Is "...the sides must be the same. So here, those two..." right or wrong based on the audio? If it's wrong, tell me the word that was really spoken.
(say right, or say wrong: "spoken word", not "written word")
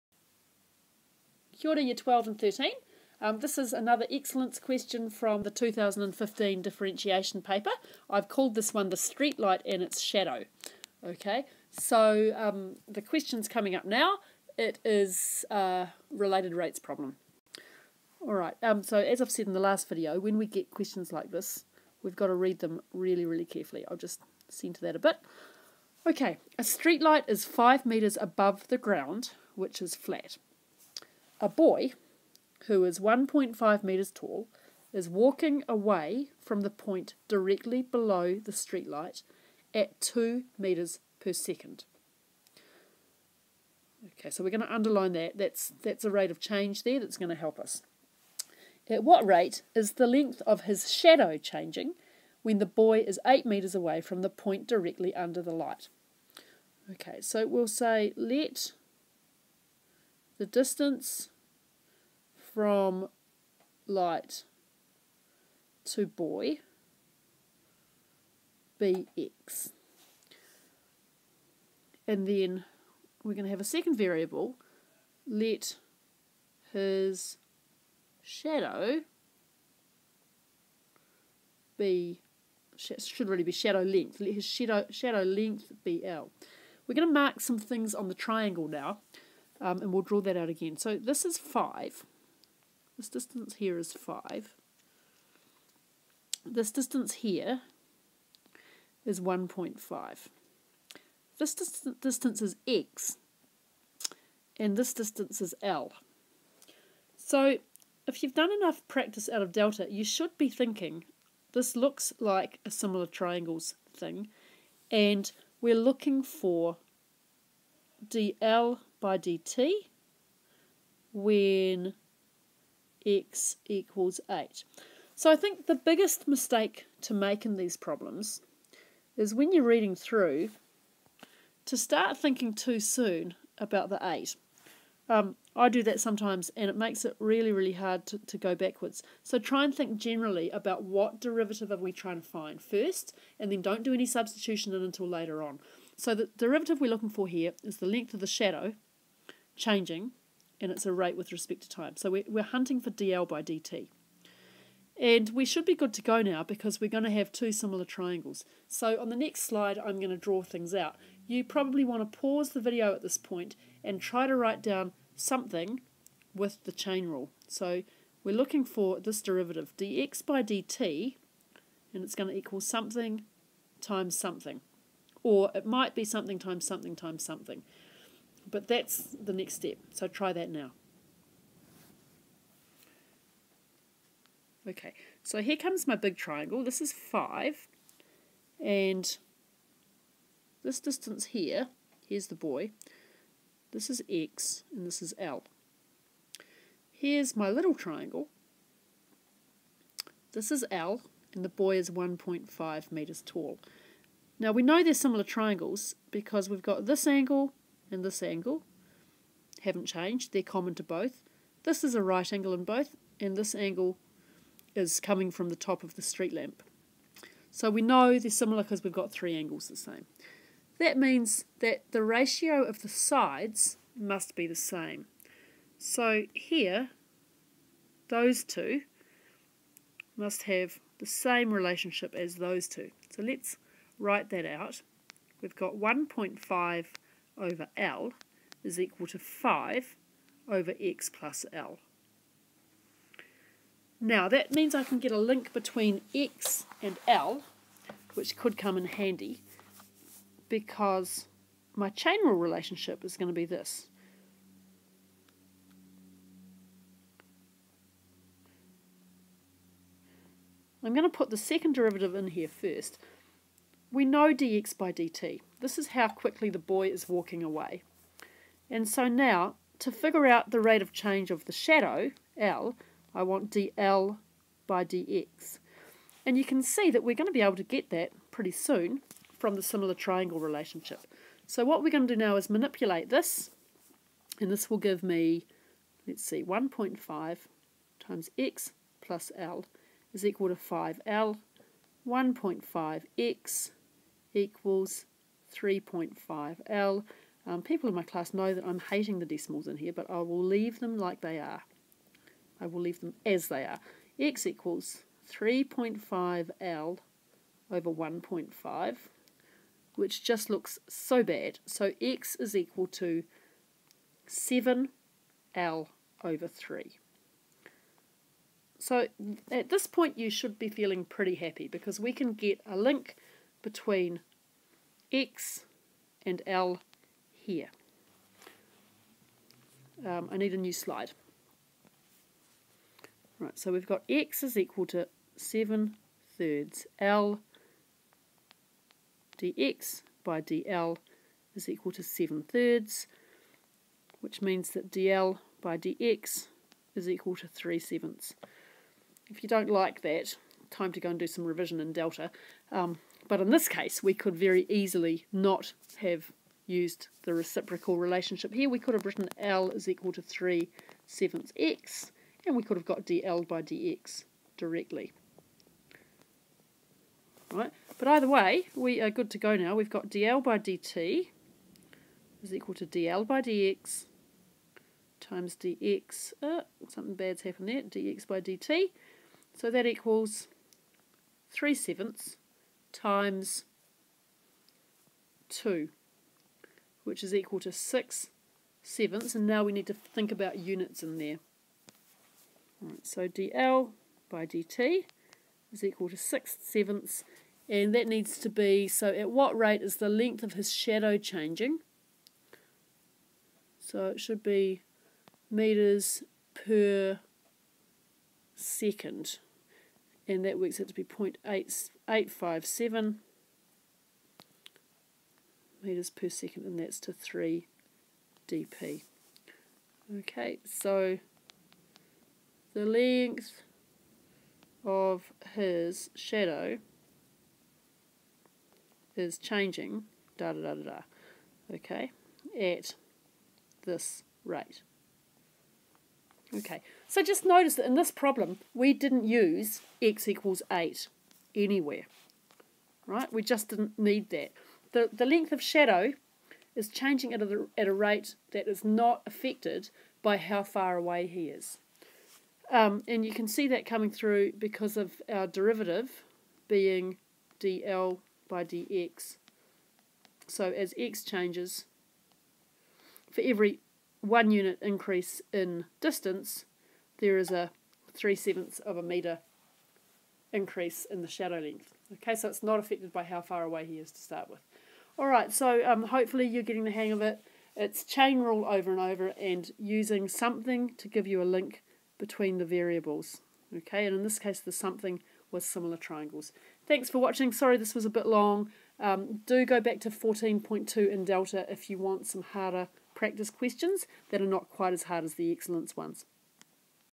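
right.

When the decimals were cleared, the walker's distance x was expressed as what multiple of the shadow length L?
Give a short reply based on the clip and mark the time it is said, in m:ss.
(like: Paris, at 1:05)
7/3 L, at 5:14.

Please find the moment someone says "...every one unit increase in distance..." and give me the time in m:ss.
7:43.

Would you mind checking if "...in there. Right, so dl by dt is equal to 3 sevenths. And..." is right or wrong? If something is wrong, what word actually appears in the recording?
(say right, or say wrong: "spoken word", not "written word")
wrong: "6", not "3".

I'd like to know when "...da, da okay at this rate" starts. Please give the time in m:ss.
7:10.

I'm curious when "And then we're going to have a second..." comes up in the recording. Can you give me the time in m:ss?
1:12.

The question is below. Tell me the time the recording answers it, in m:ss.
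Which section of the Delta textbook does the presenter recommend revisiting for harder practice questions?
8:10.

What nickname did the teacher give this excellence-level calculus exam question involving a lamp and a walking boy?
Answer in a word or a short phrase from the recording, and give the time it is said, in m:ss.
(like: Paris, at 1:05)
the streetlight and its shadow, at 0:08.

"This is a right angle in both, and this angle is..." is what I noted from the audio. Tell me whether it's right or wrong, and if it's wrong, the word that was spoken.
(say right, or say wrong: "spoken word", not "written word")
right.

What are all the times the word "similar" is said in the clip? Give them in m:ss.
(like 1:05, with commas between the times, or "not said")
1:52, 2:37, 3:24, 3:38, 4:39, 8:05.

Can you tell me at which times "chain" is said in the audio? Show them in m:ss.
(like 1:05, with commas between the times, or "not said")
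2:46, 4:11, 7:58.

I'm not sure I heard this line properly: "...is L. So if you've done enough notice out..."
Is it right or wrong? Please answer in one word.
wrong.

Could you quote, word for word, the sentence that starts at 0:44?
Okay, so we're going to underline that.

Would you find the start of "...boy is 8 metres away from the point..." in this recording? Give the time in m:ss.
0:52.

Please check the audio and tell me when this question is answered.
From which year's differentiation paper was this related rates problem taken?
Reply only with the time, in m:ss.
0:05.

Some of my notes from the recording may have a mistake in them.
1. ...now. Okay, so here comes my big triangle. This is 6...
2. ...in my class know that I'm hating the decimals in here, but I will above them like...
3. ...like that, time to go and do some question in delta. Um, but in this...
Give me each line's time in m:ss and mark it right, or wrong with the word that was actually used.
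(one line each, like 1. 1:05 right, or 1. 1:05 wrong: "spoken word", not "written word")
1. 3:00 wrong: "5", not "6"
2. 4:57 wrong: "leave", not "above"
3. 5:49 wrong: "revision", not "question".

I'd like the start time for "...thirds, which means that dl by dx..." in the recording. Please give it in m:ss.
5:42.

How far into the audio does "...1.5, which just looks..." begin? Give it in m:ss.
5:07.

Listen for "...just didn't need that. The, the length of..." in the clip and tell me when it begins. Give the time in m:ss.
7:23.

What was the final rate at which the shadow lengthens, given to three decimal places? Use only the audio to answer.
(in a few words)
0.857 metres per second.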